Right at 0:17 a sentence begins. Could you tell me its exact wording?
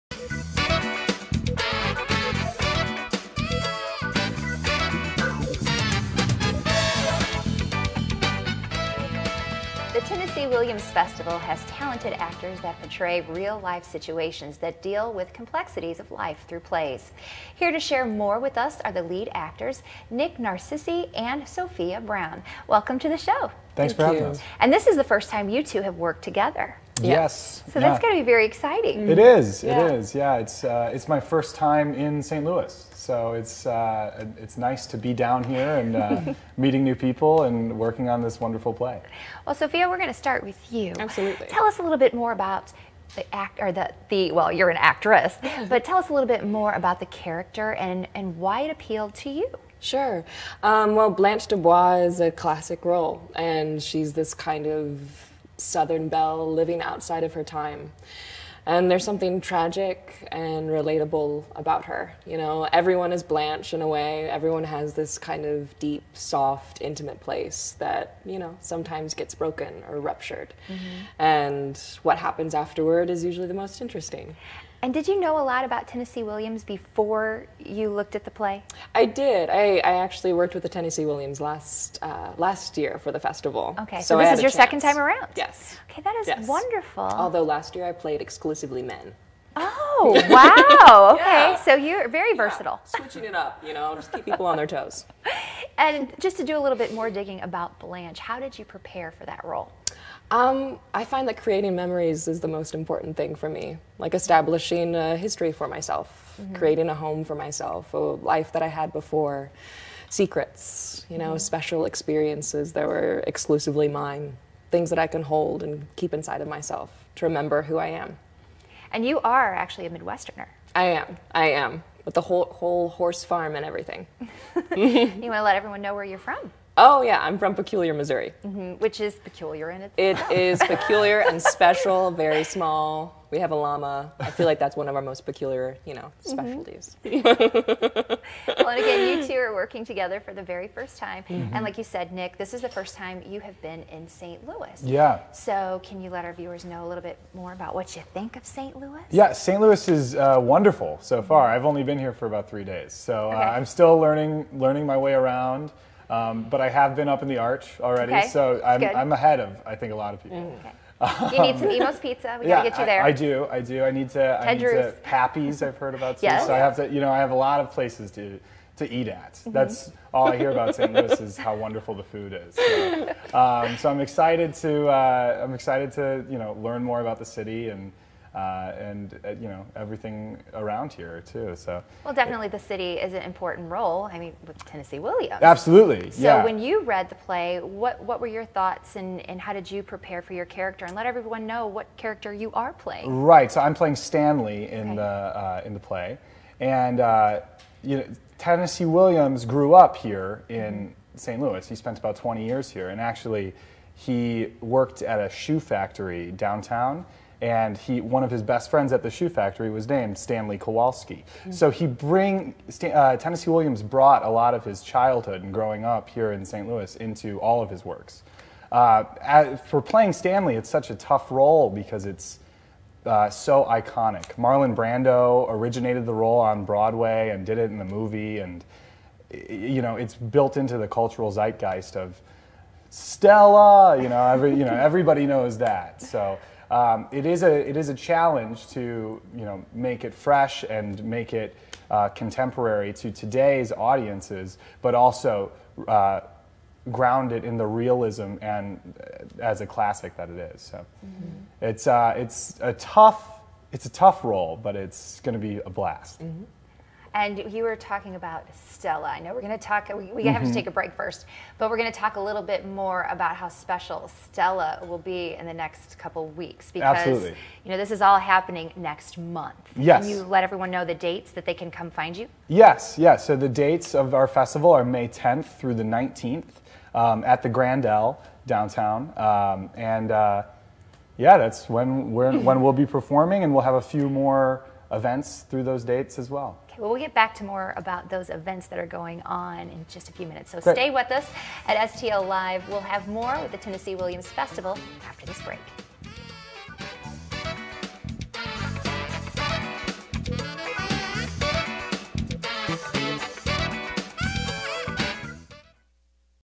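Here to share more with us are the lead actors, Nick Narcisi and Sophia Brown.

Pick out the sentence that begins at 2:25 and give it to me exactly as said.
So can you let our viewers know a little bit more about what you think of St.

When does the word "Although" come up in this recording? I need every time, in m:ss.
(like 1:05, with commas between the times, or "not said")
1:27.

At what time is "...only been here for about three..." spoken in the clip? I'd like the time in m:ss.
2:31.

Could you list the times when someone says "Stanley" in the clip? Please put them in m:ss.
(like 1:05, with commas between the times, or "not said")
3:13, 3:30, 3:40.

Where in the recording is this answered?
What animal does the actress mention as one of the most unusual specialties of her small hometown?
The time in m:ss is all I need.
2:13.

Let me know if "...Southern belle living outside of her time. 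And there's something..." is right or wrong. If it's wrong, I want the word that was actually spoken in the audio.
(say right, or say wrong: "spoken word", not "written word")
right.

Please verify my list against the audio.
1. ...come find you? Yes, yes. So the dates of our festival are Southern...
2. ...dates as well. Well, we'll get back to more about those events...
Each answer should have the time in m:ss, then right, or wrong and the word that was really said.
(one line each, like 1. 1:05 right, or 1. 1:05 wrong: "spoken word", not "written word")
1. 4:31 wrong: "May", not "Southern"
2. 4:45 right.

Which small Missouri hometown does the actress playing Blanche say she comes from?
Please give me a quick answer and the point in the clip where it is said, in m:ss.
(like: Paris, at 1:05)
Peculiar, Missouri, at 2:07.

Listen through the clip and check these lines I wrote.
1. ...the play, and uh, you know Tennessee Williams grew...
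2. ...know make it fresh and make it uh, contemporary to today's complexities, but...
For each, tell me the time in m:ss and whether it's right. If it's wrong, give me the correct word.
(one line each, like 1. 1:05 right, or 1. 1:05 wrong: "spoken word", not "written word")
1. 3:15 right
2. 3:59 wrong: "audiences", not "complexities".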